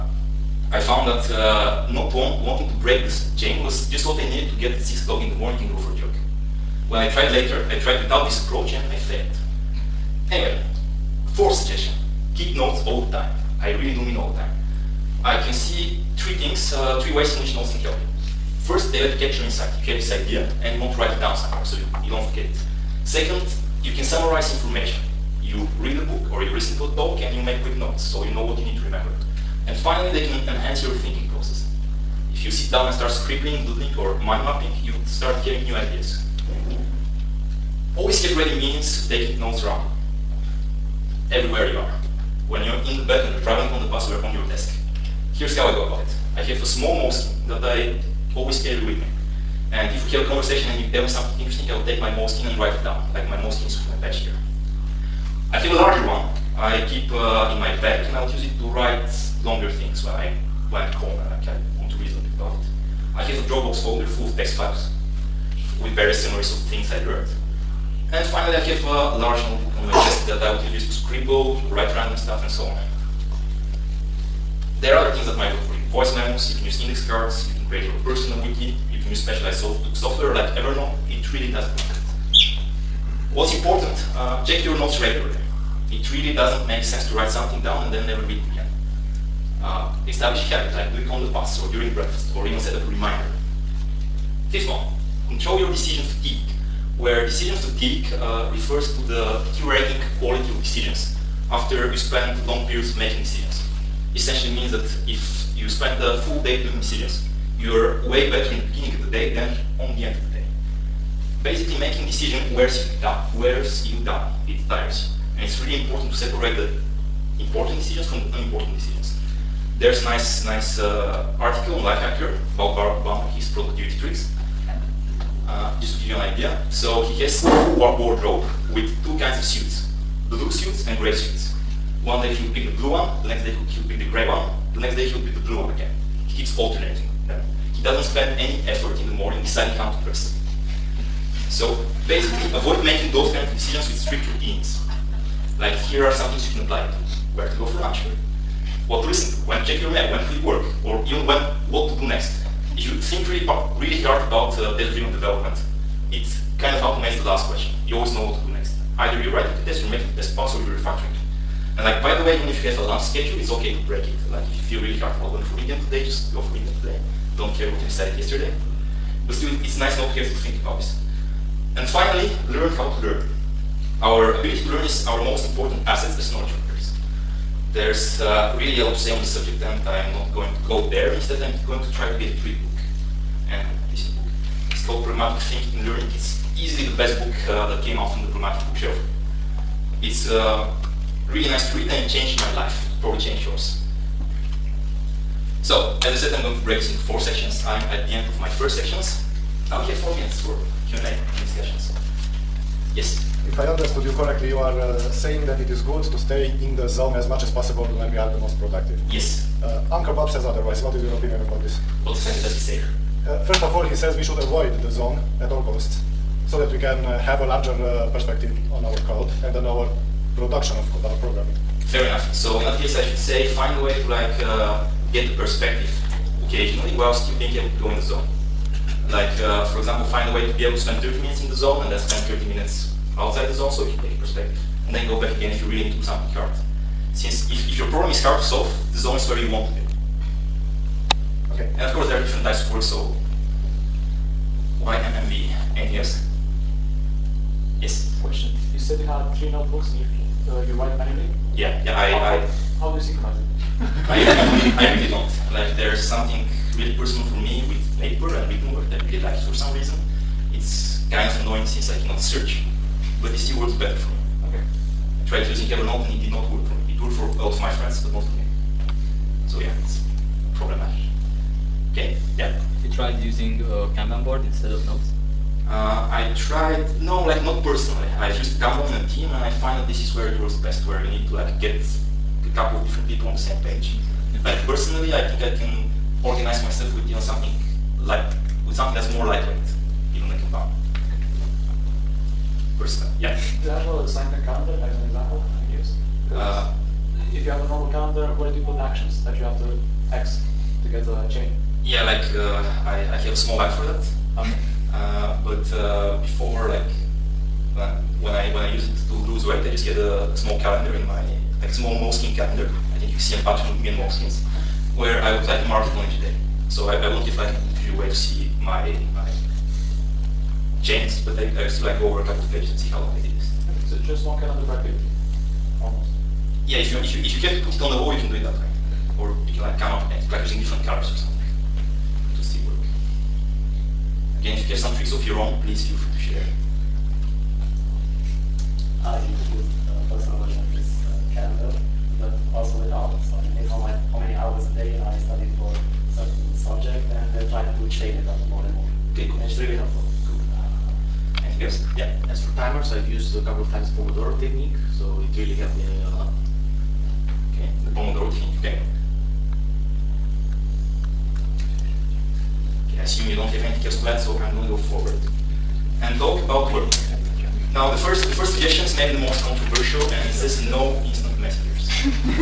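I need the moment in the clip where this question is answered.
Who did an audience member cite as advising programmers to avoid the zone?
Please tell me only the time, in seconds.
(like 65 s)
209 s.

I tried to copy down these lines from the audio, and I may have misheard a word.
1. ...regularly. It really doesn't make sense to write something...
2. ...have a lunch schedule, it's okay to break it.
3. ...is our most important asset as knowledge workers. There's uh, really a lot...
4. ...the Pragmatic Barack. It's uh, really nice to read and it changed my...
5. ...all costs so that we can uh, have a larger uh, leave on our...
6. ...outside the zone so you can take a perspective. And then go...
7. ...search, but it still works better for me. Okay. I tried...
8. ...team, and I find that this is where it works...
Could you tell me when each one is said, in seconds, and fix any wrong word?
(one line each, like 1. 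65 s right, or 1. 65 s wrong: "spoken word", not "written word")
1. 85 s right
2. 162 s right
3. 174 s right
4. 188 s wrong: "Bookshelf", not "Barack"
5. 215 s wrong: "perspective", not "leave"
6. 233 s right
7. 262 s right
8. 279 s right.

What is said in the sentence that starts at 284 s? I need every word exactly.
But personally, I think I can organize myself with you know something like with something that's more lightweight, even like Kanban.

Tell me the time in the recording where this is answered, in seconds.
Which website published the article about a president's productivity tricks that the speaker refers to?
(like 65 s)
121 s.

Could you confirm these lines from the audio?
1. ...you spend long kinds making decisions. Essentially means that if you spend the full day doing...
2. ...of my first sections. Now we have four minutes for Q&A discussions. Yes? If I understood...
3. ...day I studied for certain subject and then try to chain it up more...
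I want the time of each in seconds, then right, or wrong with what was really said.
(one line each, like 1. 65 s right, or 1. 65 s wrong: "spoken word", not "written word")
1. 101 s wrong: "periods", not "kinds"
2. 198 s right
3. 344 s right.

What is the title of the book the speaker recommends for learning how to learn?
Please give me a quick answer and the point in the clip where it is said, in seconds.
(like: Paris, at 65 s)
Pragmatic Thinking and Learning, at 185 s.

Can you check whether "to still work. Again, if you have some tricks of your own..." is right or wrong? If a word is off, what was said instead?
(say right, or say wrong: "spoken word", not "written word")
right.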